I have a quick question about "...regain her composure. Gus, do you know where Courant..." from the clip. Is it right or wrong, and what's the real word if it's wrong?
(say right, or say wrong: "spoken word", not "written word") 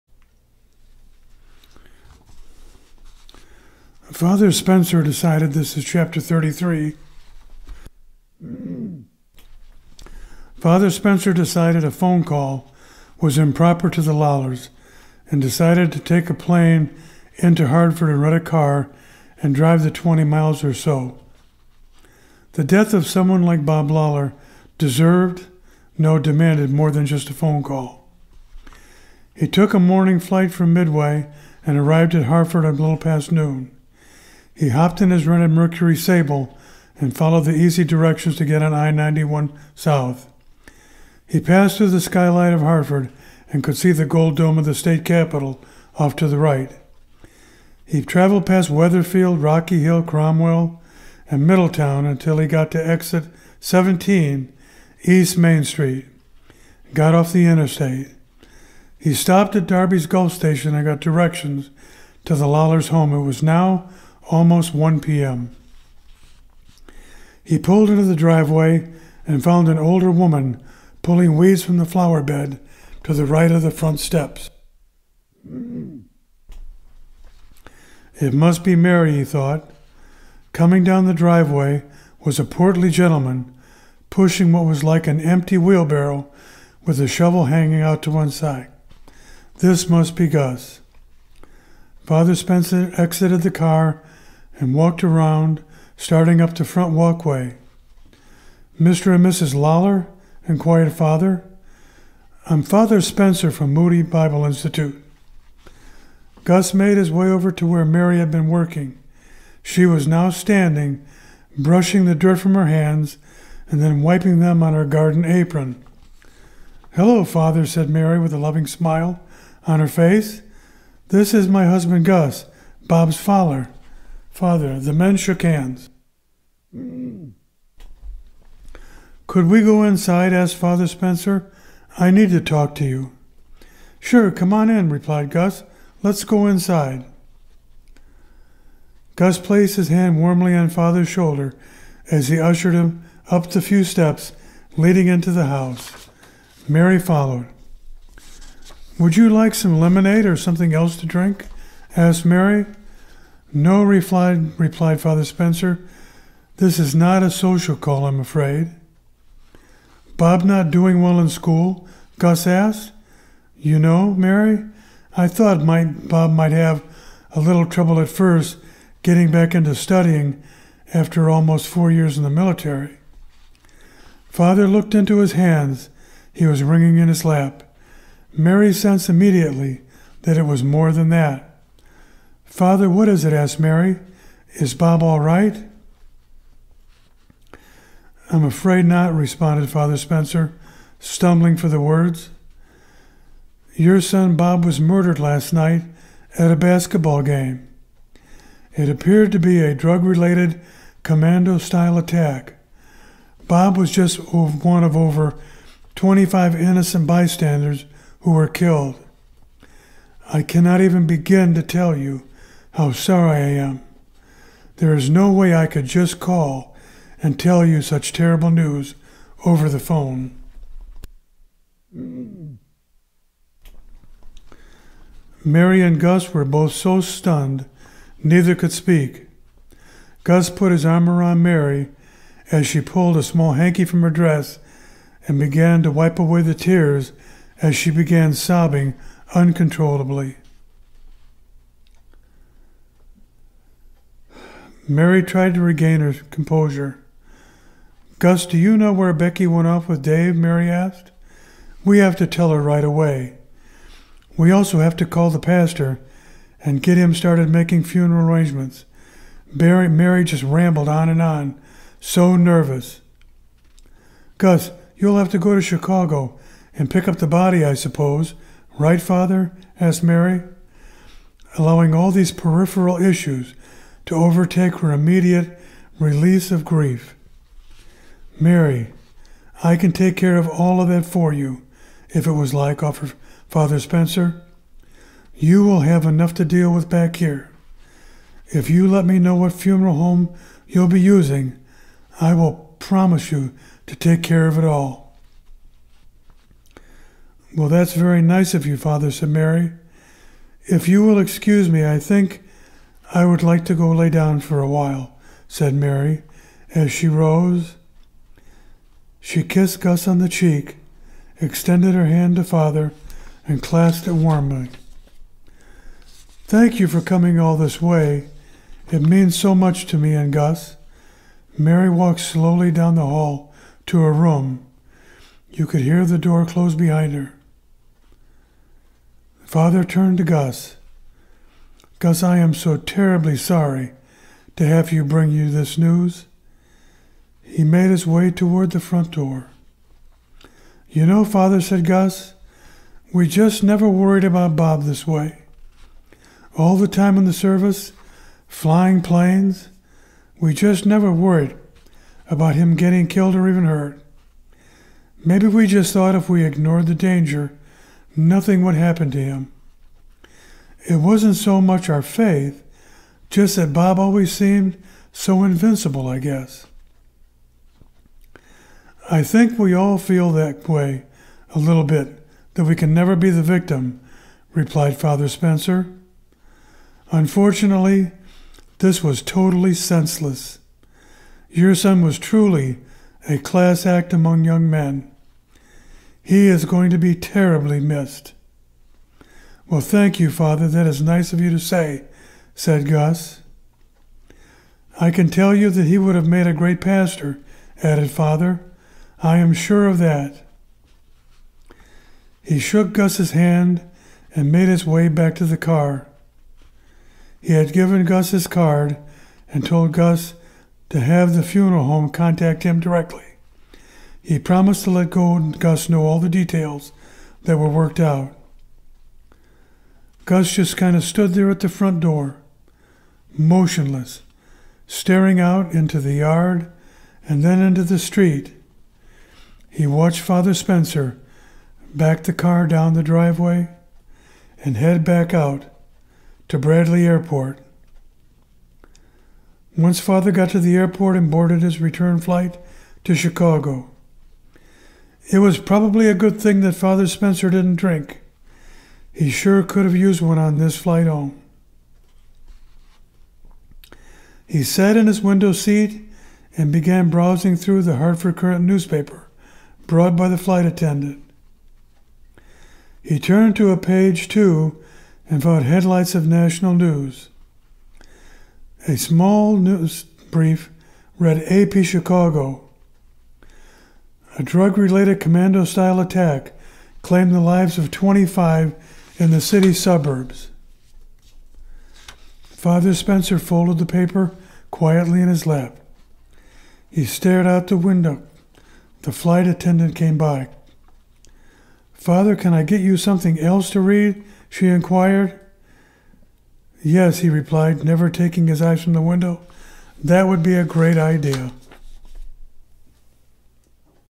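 wrong: "Becky", not "Courant".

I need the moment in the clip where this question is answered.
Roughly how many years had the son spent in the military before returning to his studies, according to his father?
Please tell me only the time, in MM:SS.
02:51.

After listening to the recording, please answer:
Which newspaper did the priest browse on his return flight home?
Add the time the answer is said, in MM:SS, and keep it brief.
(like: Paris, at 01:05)
Hartford Courant, at 07:37.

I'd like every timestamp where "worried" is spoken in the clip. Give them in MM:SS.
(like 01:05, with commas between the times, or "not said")
05:43, 05:51.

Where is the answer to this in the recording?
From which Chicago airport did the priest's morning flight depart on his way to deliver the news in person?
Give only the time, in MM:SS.
00:30.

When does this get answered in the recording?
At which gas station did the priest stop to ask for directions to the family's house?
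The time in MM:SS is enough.
00:59.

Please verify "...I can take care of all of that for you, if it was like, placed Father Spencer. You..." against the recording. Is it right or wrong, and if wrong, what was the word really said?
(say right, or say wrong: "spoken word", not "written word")
wrong: "offered", not "placed".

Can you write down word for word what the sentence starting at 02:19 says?
Gus placed his hand warmly on Father's shoulder as he ushered him up the few steps leading into the house.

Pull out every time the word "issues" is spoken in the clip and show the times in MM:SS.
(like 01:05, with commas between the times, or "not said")
04:32.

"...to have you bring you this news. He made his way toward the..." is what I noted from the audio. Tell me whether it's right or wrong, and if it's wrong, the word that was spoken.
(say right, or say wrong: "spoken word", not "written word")
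right.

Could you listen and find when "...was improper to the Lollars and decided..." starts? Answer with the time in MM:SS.
00:13.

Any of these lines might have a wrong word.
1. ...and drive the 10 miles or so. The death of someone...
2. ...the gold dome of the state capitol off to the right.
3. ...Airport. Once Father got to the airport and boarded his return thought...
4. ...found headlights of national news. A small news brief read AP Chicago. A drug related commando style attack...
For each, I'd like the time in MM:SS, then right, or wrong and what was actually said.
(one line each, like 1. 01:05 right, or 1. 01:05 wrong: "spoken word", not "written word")
1. 00:19 wrong: "20", not "10"
2. 00:43 right
3. 07:17 wrong: "flight", not "thought"
4. 07:45 right.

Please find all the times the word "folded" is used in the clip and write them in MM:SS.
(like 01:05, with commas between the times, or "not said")
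08:03.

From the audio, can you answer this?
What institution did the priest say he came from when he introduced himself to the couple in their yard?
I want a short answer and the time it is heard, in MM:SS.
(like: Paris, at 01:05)
Moody Bible Institute, at 01:43.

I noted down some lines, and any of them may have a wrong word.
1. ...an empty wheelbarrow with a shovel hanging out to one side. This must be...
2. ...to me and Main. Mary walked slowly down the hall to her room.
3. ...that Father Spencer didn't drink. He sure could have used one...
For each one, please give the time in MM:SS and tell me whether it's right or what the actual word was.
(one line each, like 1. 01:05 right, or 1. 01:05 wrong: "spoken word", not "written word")
1. 01:25 right
2. 05:19 wrong: "Gus", not "Main"
3. 07:26 right.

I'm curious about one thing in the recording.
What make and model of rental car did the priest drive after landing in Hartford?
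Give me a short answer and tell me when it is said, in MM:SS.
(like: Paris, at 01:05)
Mercury Sable, at 00:35.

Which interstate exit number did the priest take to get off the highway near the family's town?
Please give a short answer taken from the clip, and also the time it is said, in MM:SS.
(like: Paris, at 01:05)
17, at 00:53.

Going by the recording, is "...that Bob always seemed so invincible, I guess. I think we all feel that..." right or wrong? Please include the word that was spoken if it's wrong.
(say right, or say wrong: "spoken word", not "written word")
right.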